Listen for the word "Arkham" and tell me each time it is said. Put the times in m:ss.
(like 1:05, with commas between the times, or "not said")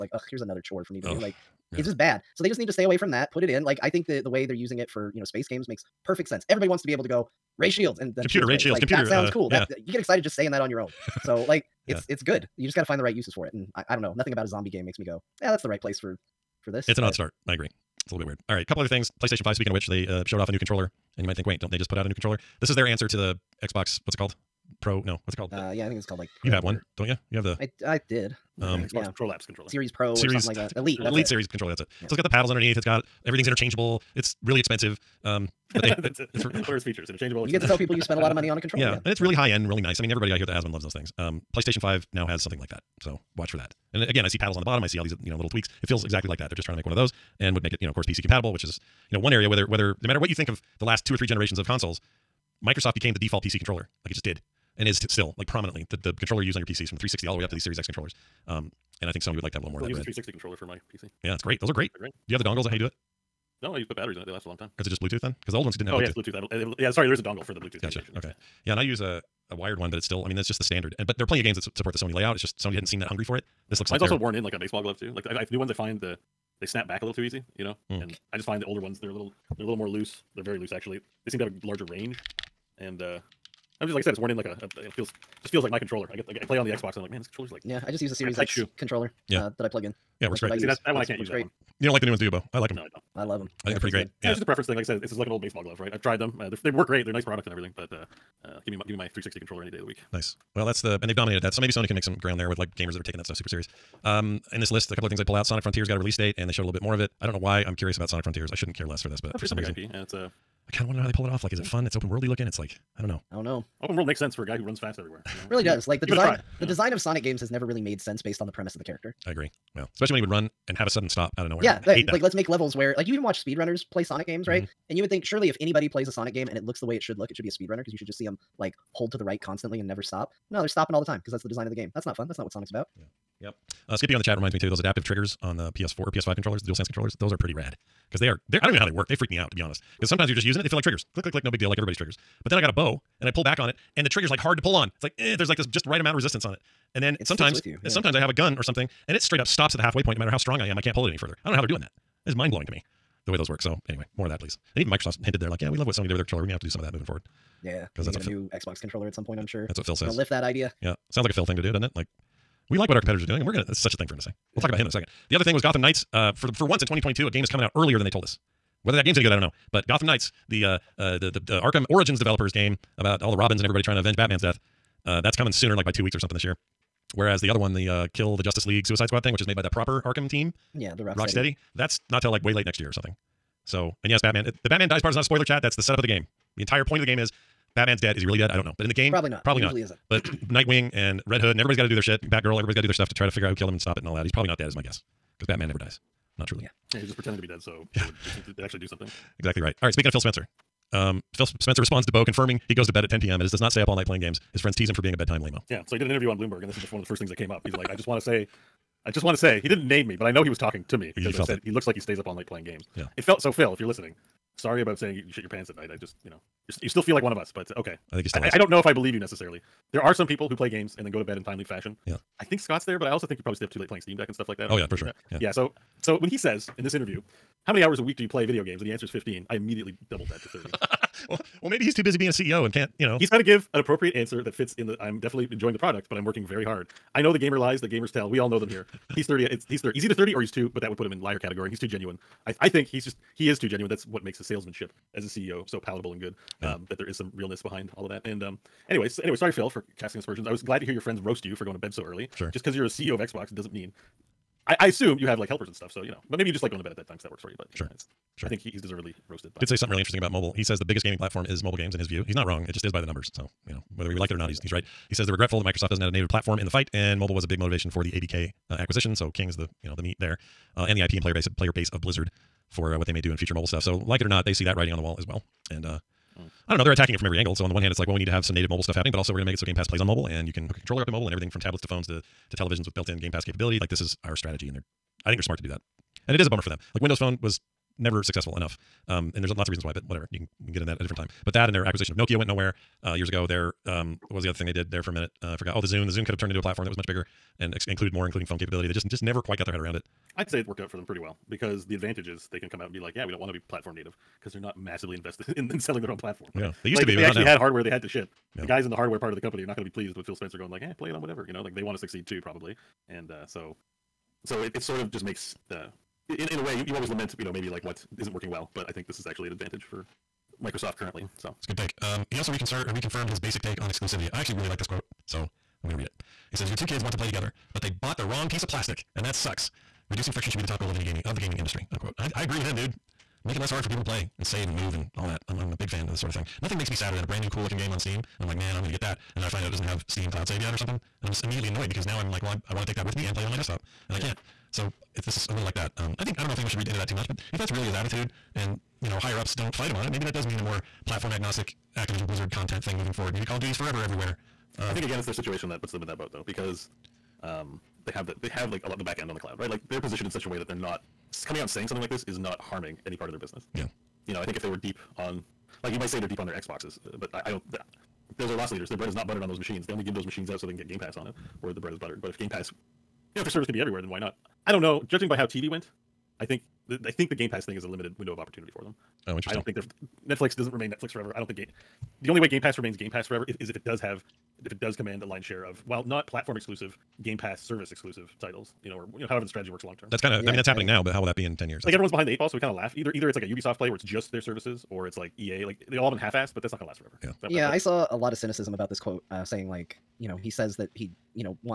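2:51, 3:00.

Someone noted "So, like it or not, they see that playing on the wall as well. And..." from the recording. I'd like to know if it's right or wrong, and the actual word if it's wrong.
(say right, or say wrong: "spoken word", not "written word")
wrong: "writing", not "playing".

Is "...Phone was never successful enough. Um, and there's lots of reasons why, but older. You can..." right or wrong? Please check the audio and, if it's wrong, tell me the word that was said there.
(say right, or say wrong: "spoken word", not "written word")
wrong: "whatever", not "older".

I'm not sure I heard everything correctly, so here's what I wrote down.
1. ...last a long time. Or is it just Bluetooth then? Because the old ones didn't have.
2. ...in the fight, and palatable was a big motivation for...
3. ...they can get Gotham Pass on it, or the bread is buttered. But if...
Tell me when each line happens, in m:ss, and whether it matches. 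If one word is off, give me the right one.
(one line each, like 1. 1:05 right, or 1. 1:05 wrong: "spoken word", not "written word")
1. 1:04 right
2. 4:26 wrong: "mobile", not "palatable"
3. 6:10 wrong: "Game", not "Gotham".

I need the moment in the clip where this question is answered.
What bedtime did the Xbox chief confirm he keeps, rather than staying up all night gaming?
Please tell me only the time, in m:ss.
3:23.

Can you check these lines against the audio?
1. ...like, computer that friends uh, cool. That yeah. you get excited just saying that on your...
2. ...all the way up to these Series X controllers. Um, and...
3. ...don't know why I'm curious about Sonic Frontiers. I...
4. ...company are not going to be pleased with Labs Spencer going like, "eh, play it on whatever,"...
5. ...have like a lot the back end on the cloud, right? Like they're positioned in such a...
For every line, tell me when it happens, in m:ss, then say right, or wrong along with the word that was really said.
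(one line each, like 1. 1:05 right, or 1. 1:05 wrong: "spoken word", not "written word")
1. 0:08 wrong: "sounds", not "friends"
2. 0:57 right
3. 1:47 right
4. 5:09 wrong: "Phil", not "Labs"
5. 5:58 right.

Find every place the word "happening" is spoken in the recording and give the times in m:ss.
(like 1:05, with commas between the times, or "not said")
4:38, 6:30.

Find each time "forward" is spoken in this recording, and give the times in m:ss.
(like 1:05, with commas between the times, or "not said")
2:37, 5:53.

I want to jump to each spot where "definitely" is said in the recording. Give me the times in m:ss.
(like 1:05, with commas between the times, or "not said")
3:55.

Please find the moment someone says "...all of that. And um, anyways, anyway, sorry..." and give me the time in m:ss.
4:07.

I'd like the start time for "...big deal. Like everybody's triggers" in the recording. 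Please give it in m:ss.
2:21.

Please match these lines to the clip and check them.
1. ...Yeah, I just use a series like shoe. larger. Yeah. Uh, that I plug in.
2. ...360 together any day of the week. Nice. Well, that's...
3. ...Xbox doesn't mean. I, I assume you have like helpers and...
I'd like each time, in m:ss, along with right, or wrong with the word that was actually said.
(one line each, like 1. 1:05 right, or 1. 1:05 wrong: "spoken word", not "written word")
1. 1:27 wrong: "controller", not "larger"
2. 1:39 wrong: "controller", not "together"
3. 4:13 right.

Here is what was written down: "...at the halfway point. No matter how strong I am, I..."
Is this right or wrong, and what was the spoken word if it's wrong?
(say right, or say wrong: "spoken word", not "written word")
right.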